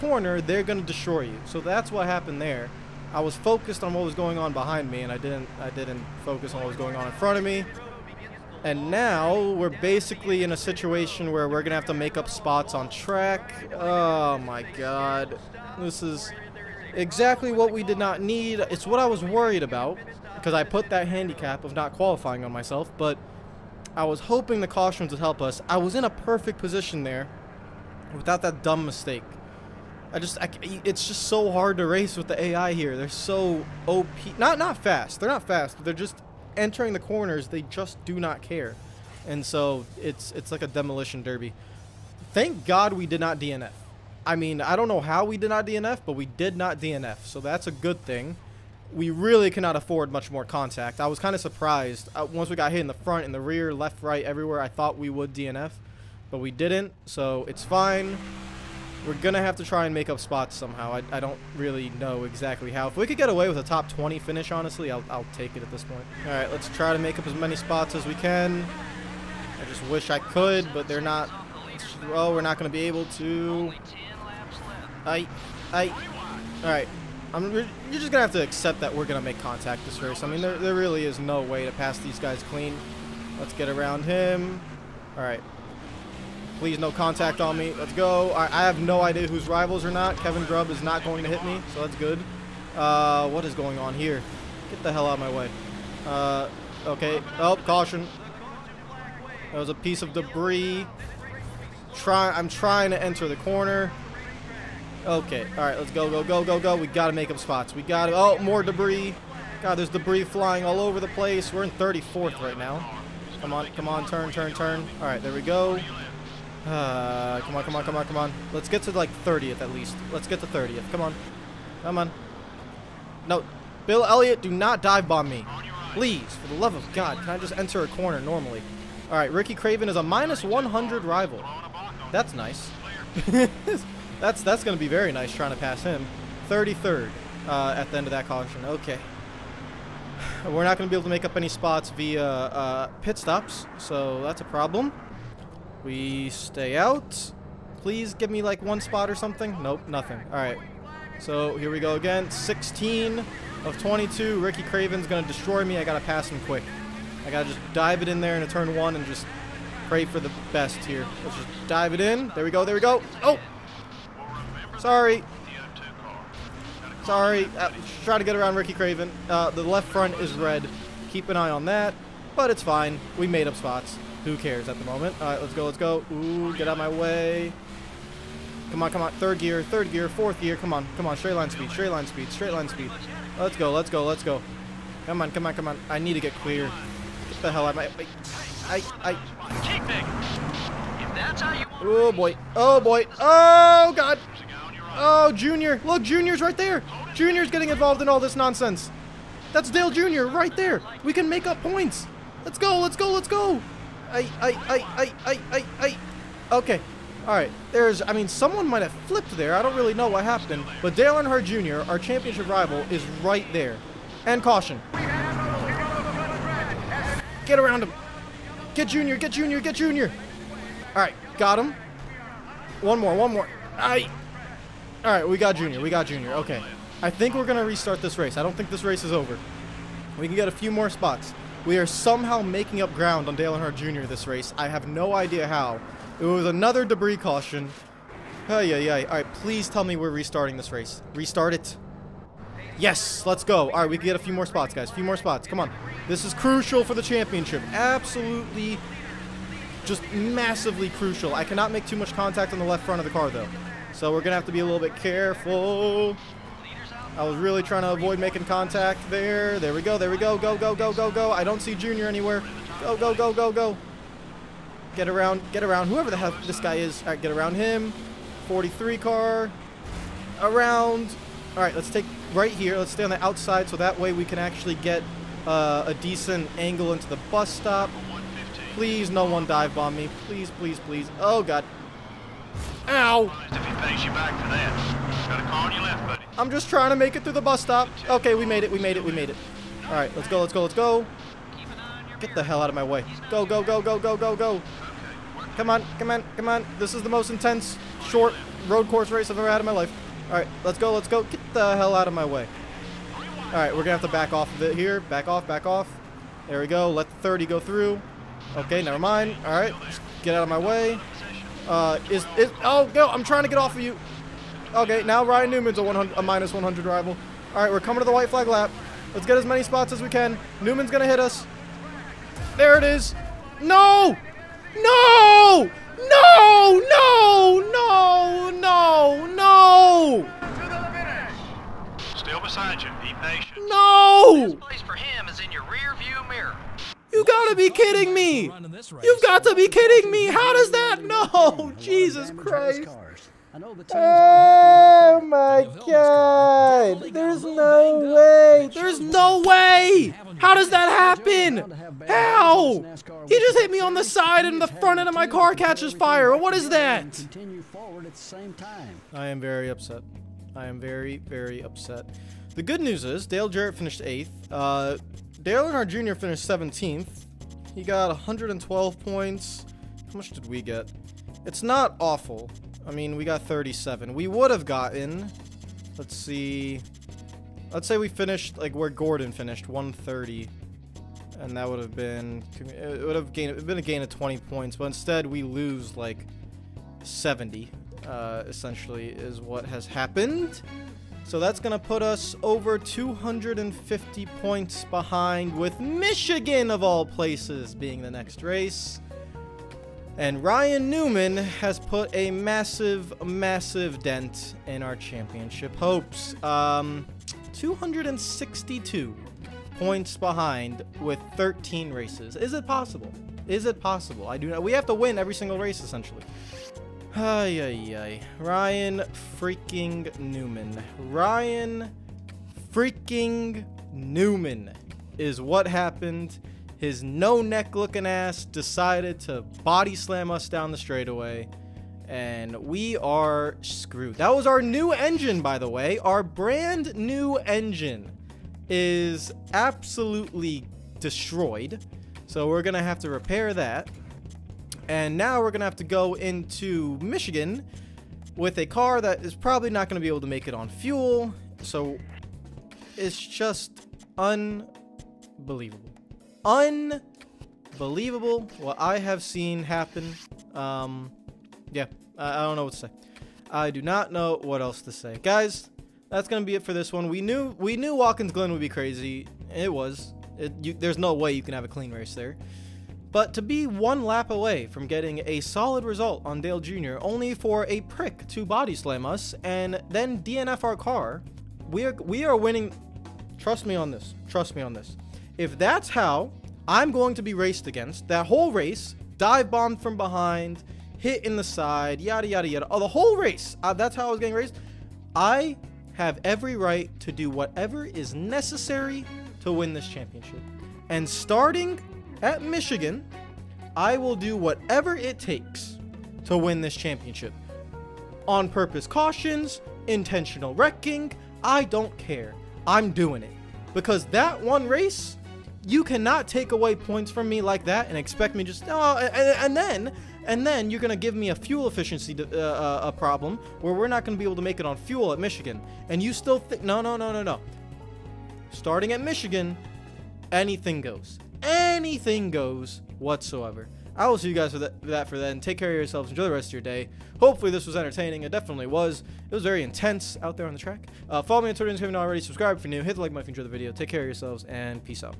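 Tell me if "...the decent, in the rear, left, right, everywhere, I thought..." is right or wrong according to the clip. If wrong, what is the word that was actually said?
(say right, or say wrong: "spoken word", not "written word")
wrong: "front", not "decent".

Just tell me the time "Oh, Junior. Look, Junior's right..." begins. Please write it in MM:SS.
03:14.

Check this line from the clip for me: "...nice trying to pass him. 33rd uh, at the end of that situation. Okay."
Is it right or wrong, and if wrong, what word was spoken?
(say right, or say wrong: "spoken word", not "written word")
wrong: "caution", not "situation".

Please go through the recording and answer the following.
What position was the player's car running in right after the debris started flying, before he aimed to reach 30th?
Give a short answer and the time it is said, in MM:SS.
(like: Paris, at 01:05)
34th, at 01:51.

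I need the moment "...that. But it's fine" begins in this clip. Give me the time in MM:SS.
02:51.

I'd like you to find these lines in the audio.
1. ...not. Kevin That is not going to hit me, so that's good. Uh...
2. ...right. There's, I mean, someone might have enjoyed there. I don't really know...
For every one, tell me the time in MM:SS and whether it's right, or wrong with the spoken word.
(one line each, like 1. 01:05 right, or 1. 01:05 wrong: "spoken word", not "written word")
1. 01:29 wrong: "Grubb", not "That"
2. 03:27 wrong: "flipped", not "enjoyed".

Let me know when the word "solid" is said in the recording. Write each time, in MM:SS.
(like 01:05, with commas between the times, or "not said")
07:55.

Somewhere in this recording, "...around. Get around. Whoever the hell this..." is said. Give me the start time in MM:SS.
04:25.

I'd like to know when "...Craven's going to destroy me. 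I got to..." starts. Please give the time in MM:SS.
02:34.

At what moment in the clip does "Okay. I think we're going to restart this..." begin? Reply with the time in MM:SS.
03:46.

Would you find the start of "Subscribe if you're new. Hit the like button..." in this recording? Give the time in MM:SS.
09:02.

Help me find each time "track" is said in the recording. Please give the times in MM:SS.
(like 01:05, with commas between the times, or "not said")
00:12, 09:00.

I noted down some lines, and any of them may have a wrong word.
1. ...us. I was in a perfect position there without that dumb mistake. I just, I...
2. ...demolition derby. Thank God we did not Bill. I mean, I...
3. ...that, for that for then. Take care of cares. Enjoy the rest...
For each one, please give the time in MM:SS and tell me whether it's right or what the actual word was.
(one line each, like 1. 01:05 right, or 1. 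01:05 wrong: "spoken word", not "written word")
1. 00:25 right
2. 00:40 wrong: "DNF", not "Bill"
3. 08:54 wrong: "yourselves", not "cares".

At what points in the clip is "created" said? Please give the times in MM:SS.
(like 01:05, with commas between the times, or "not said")
not said.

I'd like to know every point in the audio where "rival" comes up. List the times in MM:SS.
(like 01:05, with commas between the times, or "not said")
01:29, 02:11, 03:32, 05:16.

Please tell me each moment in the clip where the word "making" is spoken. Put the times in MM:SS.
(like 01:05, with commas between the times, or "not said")
03:52, 04:18.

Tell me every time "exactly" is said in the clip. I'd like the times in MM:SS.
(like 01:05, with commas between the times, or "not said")
00:16, 01:02.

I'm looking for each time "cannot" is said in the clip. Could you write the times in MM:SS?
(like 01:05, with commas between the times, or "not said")
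00:49, 04:11, 08:35.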